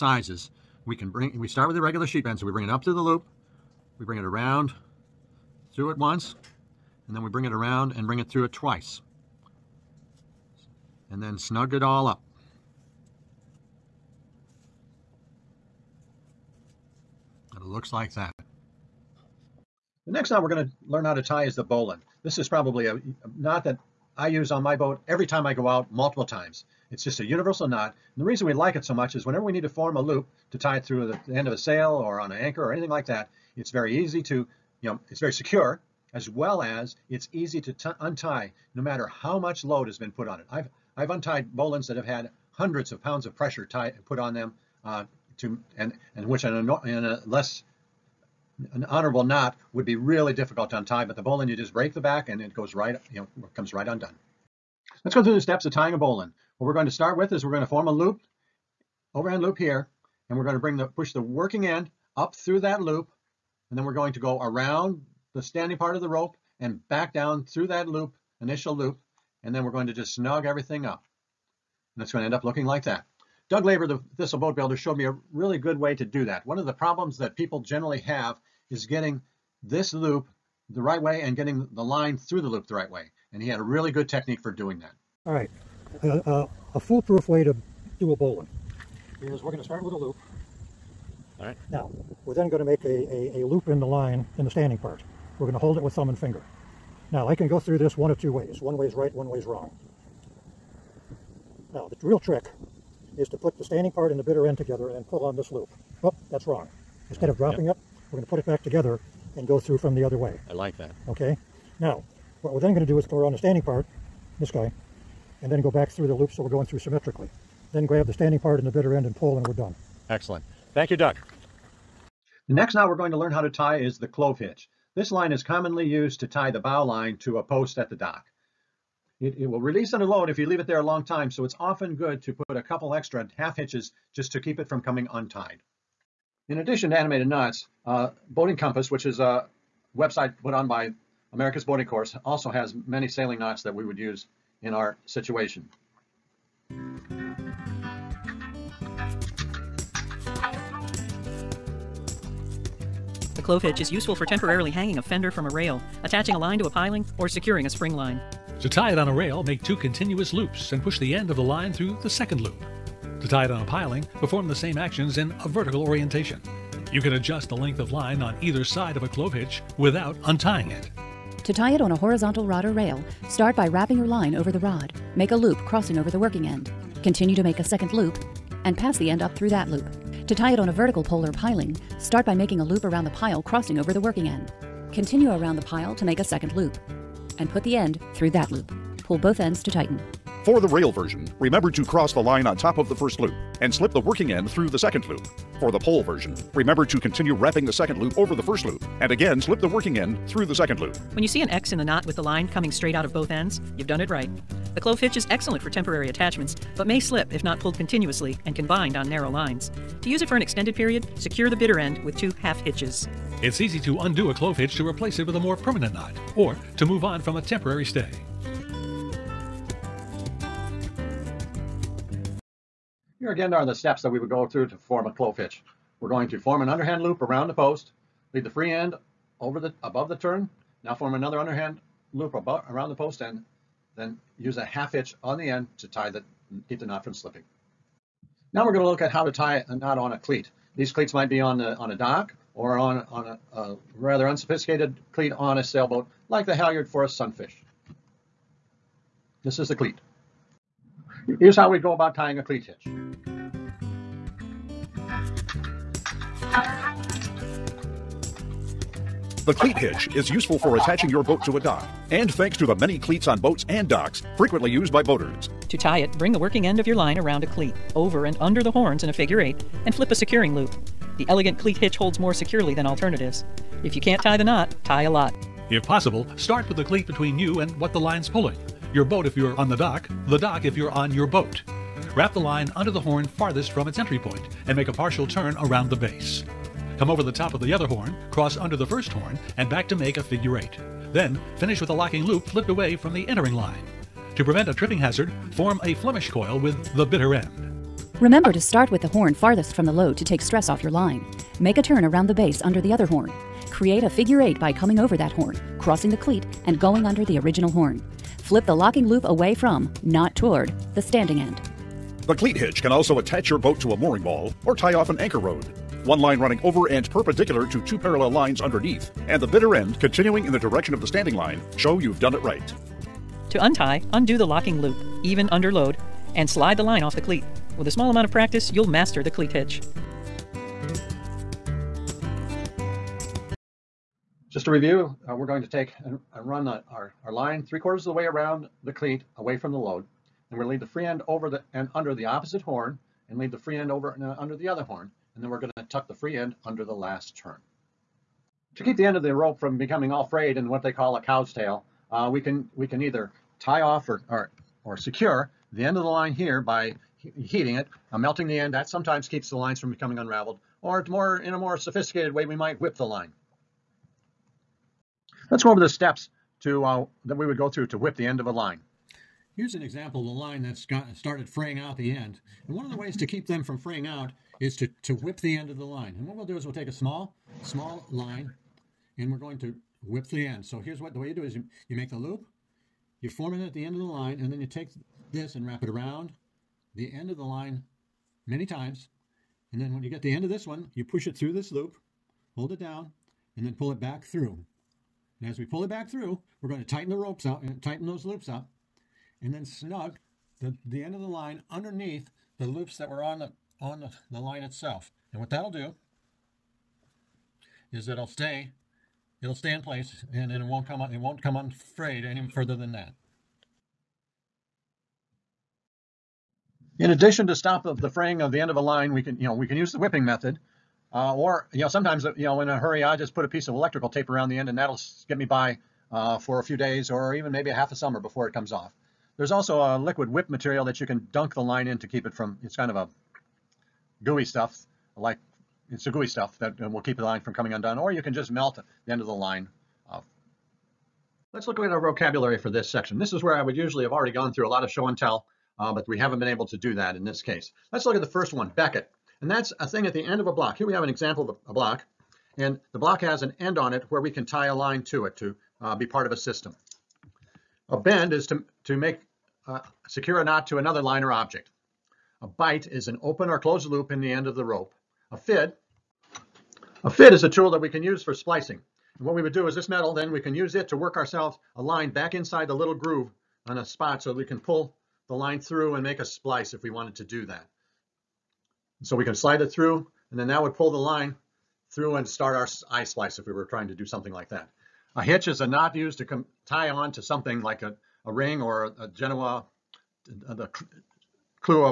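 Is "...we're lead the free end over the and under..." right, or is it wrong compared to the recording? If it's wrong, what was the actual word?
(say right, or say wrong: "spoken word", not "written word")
right.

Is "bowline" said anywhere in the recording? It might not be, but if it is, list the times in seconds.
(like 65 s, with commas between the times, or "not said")
21 s, 41 s, 51 s, 55 s, 88 s.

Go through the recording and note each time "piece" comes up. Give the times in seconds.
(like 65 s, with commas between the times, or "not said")
423 s.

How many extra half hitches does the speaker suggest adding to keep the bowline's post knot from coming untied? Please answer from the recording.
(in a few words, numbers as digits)
2.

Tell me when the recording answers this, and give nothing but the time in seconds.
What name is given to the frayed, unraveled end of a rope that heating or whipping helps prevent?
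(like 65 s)
351 s.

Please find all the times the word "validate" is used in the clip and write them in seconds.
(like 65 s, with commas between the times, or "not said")
not said.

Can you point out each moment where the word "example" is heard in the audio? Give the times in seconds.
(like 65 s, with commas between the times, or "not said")
369 s, 451 s.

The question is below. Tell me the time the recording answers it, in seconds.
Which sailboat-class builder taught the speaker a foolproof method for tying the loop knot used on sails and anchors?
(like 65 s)
73 s.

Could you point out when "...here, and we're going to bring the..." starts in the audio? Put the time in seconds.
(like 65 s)
59 s.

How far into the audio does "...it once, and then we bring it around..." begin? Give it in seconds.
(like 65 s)
5 s.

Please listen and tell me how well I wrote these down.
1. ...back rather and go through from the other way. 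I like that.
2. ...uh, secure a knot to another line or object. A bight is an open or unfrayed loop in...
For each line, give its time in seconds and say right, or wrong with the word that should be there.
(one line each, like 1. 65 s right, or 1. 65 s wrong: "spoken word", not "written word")
1. 108 s wrong: "together", not "rather"
2. 459 s wrong: "closed", not "unfrayed".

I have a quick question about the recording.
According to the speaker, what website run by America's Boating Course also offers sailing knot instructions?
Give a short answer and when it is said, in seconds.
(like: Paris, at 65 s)
Boating Compass, at 138 s.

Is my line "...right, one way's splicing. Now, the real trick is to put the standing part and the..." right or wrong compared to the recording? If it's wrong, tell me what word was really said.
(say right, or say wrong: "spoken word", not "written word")
wrong: "wrong", not "splicing".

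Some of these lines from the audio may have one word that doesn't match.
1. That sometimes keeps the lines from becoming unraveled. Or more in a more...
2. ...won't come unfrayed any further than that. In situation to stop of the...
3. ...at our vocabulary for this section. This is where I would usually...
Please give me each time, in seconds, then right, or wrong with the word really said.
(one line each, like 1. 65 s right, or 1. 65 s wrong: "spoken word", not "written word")
1. 358 s right
2. 411 s wrong: "addition", not "situation"
3. 441 s right.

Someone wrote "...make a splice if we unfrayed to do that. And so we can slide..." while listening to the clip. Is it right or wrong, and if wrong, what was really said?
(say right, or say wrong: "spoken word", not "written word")
wrong: "wanted", not "unfrayed".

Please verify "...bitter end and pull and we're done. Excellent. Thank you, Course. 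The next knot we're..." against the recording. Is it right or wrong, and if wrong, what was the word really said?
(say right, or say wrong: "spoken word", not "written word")
wrong: "Doug", not "Course".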